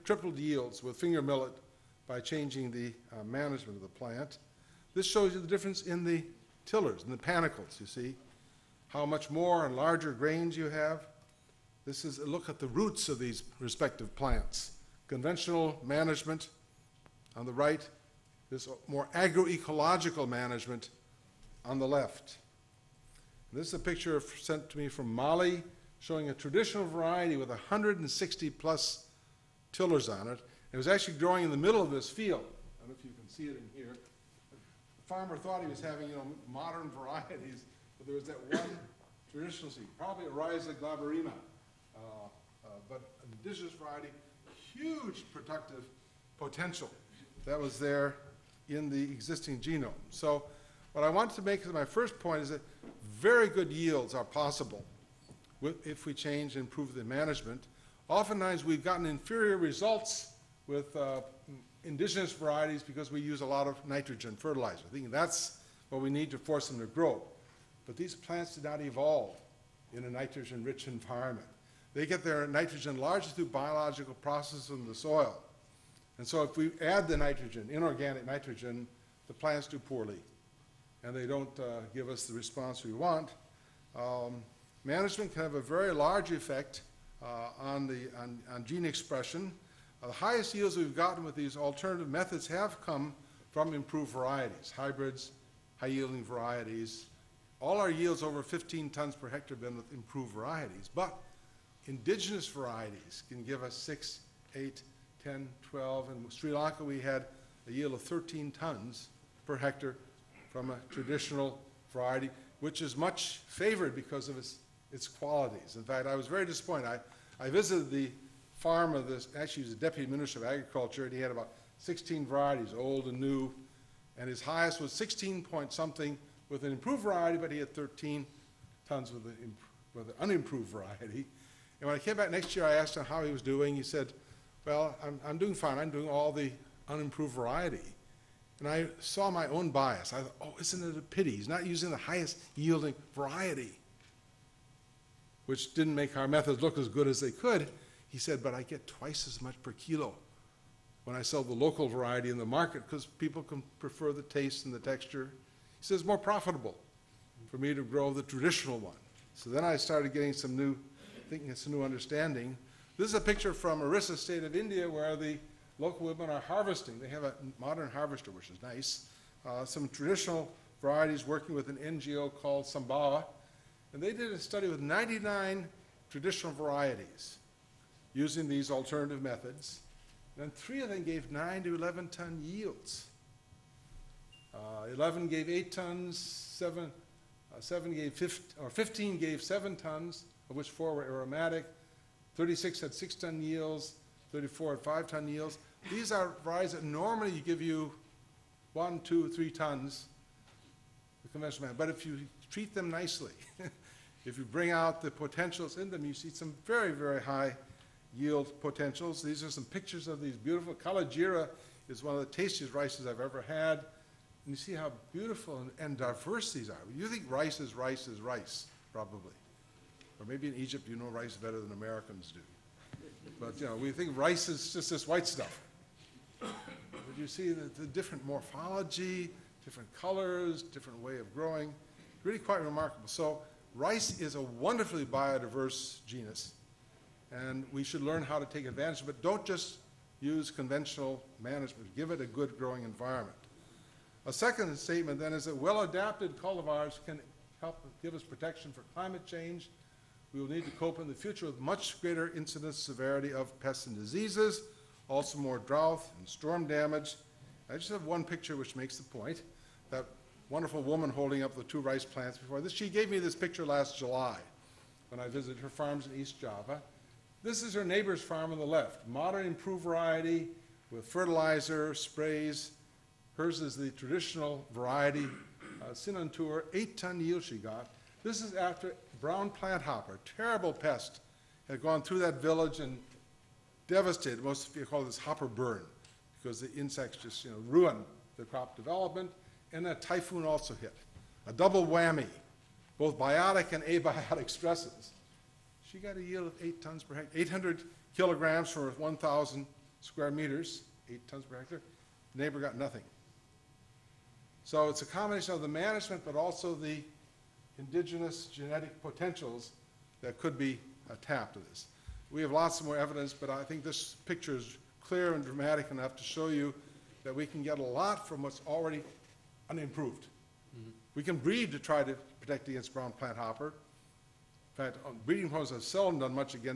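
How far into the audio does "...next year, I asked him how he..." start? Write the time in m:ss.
2:12.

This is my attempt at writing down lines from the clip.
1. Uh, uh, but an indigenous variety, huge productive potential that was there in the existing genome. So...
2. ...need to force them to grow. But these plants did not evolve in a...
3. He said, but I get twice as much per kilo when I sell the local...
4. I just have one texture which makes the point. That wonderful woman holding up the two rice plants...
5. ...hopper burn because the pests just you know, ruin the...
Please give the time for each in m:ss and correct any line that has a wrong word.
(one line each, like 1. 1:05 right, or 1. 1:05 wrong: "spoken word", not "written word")
1. 0:41 right
2. 1:06 right
3. 2:28 right
4. 4:17 wrong: "picture", not "texture"
5. 4:45 wrong: "insects", not "pests".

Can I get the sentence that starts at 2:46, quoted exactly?
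They have a modern harvester, which is nice.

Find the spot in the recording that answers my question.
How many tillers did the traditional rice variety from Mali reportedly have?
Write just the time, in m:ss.
0:27.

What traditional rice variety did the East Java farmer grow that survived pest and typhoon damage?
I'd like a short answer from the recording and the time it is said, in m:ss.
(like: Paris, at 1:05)
Sintanur, at 4:35.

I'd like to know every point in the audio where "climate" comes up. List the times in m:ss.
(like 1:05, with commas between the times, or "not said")
4:08.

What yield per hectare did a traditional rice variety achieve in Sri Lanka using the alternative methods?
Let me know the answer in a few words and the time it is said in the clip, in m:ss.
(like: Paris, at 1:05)
13 tons, at 1:48.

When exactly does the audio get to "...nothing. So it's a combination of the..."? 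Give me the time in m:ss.
5:02.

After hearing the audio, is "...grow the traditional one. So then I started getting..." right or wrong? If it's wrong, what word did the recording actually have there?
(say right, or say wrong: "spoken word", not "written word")
right.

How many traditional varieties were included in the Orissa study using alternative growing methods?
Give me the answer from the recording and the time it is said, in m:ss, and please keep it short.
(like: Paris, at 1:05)
99, at 2:54.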